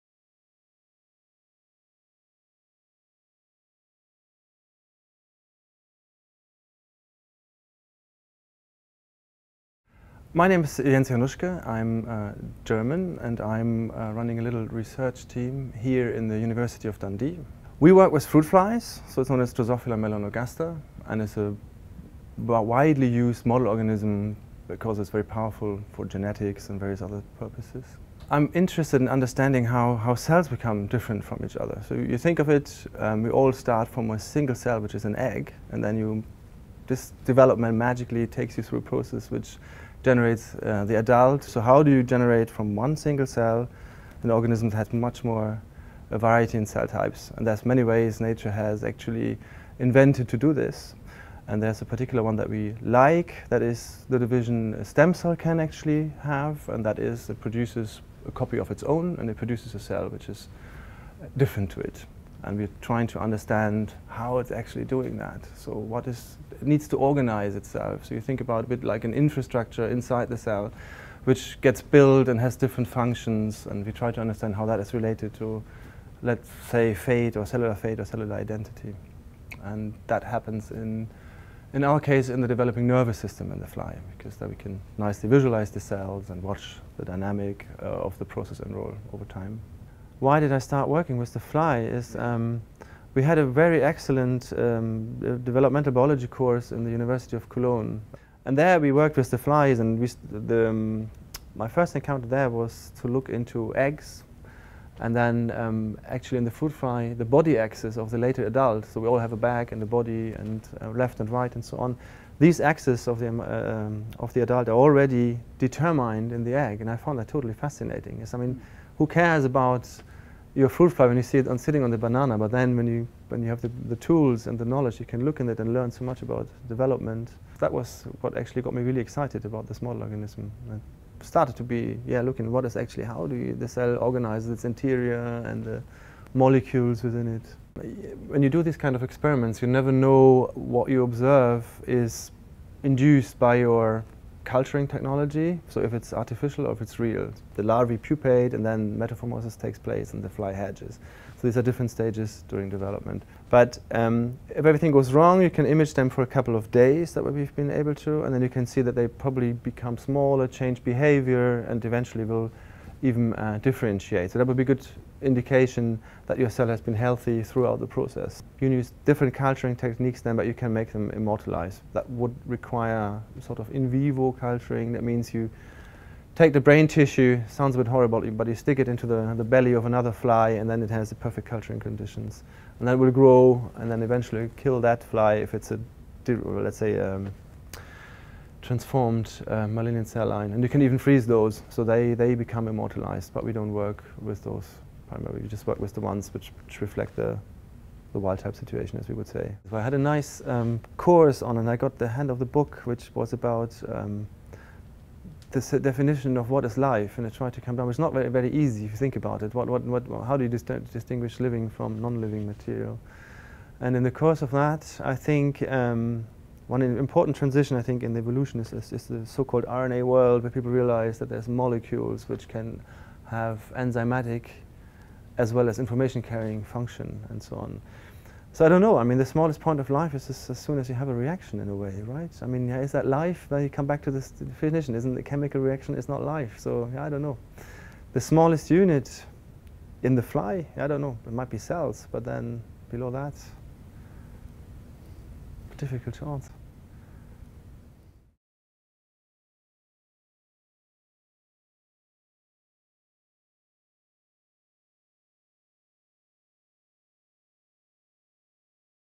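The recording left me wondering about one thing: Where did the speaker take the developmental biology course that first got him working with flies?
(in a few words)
University of Cologne.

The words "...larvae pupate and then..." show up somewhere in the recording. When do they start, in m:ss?
2:27.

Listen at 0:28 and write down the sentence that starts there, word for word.
I'm interested in understanding how, how cells become different from each other.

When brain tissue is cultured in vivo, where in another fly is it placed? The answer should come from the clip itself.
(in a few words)
the belly.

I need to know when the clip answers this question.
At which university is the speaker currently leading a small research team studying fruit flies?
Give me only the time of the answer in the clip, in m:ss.
0:16.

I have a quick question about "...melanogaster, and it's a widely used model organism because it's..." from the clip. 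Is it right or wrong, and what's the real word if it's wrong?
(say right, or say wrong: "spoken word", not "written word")
right.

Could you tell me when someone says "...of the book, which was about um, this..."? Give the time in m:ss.
3:22.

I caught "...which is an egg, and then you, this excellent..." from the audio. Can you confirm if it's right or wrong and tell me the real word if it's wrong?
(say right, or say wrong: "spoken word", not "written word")
wrong: "development", not "excellent".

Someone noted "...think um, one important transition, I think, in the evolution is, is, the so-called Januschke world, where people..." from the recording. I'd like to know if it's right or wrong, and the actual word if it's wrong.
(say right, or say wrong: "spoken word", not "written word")
wrong: "RNA", not "Januschke".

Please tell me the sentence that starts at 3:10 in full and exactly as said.
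And you can even freeze those, so they, they become immortalized, but we don't work with those primarily.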